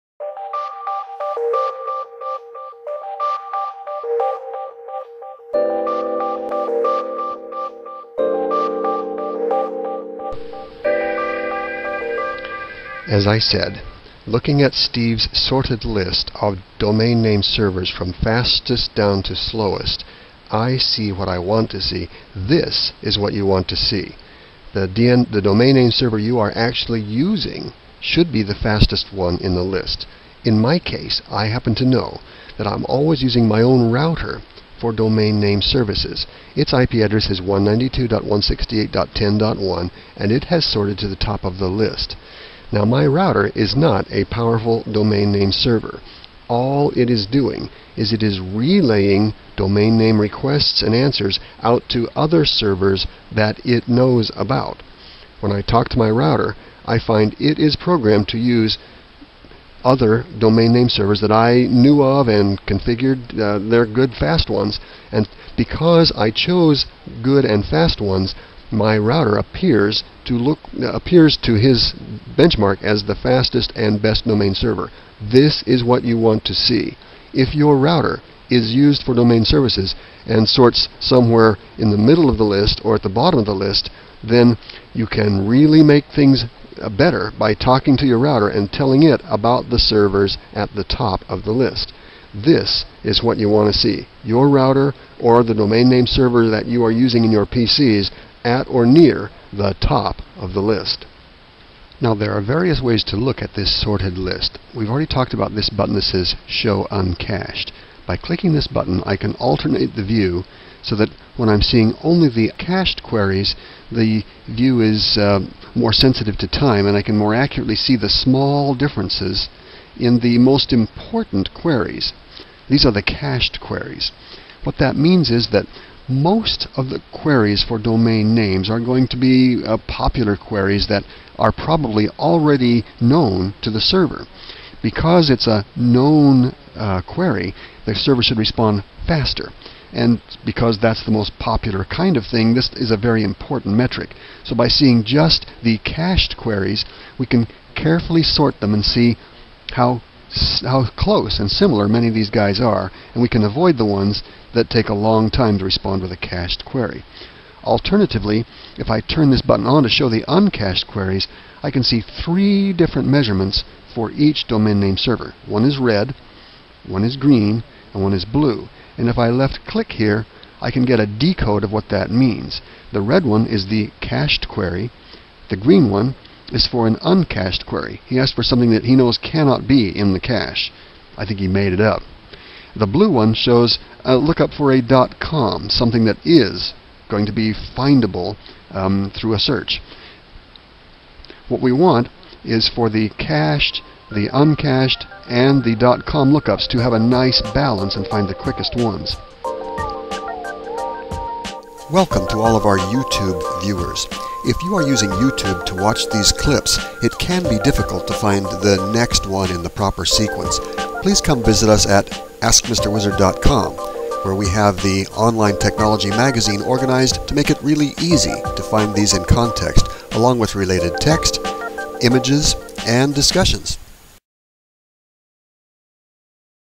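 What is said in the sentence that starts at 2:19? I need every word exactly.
And because that's the most popular kind of thing, this is a very important metric.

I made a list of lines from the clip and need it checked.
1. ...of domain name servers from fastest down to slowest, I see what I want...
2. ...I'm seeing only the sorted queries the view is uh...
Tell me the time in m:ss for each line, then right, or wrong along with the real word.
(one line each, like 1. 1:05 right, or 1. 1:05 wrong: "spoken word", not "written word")
1. 0:16 right
2. 1:51 wrong: "cached", not "sorted".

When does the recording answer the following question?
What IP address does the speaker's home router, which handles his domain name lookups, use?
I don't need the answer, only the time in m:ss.
0:37.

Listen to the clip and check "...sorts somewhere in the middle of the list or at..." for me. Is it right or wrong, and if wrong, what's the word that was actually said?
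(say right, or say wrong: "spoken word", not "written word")
right.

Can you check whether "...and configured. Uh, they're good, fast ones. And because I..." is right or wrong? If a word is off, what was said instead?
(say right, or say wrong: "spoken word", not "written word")
right.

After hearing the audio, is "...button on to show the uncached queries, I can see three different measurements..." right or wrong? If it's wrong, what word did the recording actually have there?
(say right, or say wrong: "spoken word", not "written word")
right.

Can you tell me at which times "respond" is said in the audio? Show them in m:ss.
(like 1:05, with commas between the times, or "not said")
2:18, 2:35.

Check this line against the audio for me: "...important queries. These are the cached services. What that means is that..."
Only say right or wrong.
wrong.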